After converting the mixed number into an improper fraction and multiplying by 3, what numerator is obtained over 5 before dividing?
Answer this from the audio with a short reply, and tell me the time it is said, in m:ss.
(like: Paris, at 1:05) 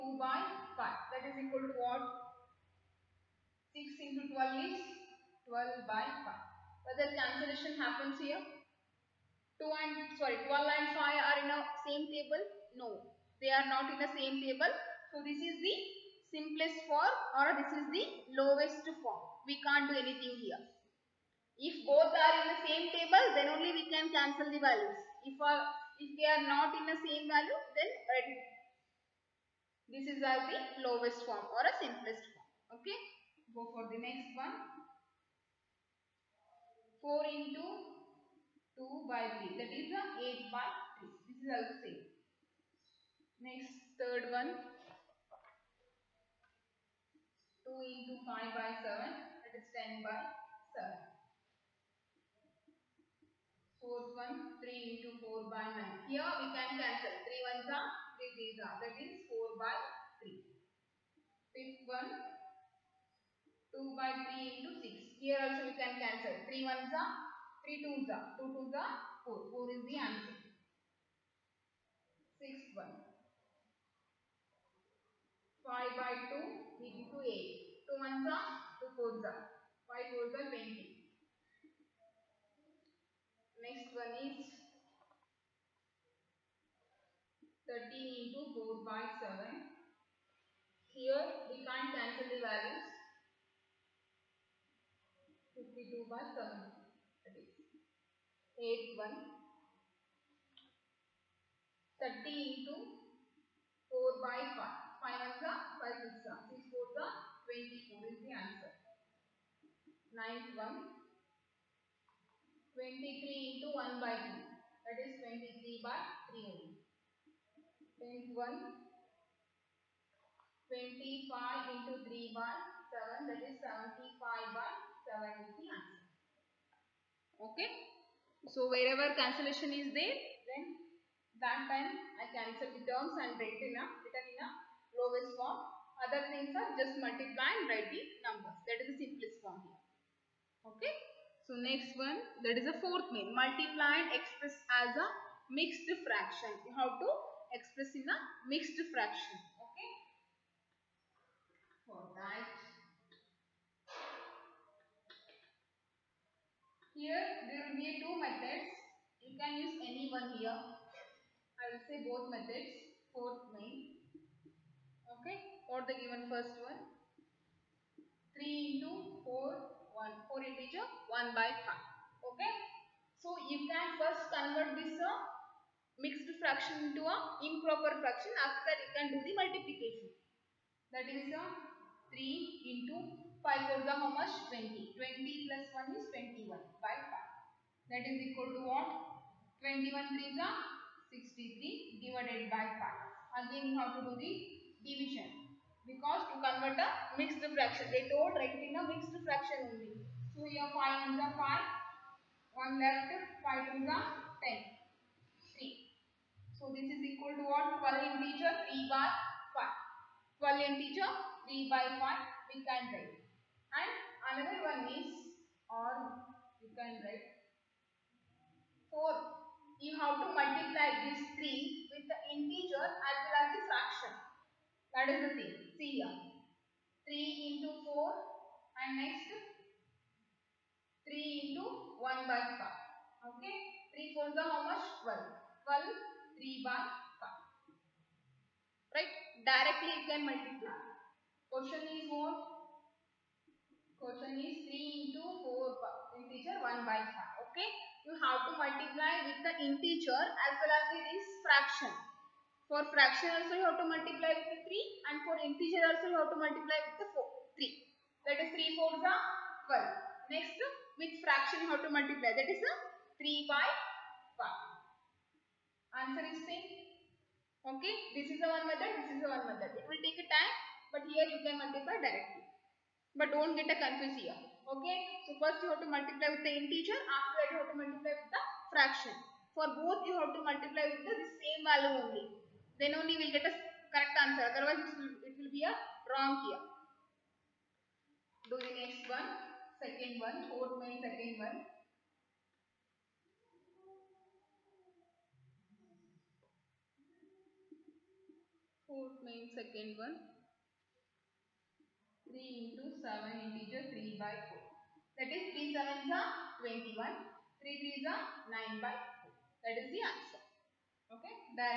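63, at 3:11.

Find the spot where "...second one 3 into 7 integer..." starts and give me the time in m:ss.
4:59.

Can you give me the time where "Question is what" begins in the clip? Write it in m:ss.
4:01.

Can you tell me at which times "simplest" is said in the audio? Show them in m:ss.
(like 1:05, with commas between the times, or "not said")
0:16, 0:31, 2:18.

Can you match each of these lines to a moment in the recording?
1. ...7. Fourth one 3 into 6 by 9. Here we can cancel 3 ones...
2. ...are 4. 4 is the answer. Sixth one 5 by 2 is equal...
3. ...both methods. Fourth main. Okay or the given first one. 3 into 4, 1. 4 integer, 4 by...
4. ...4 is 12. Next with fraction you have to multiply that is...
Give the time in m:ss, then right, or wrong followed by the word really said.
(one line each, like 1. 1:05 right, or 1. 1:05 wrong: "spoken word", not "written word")
1. 0:50 wrong: "4", not "6"
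2. 1:08 right
3. 2:42 wrong: "1", not "4"
4. 4:19 right.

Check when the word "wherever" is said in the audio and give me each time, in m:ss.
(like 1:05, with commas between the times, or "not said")
2:08.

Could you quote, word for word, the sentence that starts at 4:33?
But don't get a confused here.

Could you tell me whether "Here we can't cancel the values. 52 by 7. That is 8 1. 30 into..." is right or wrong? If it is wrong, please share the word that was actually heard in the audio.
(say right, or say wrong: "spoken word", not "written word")
right.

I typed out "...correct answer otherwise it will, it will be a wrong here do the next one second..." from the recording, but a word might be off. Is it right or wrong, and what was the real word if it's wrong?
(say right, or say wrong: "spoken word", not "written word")
right.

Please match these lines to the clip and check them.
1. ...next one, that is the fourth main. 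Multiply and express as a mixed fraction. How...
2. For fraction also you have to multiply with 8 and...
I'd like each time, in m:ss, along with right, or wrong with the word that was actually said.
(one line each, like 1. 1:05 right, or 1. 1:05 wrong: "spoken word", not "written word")
1. 2:21 right
2. 4:12 wrong: "3", not "8".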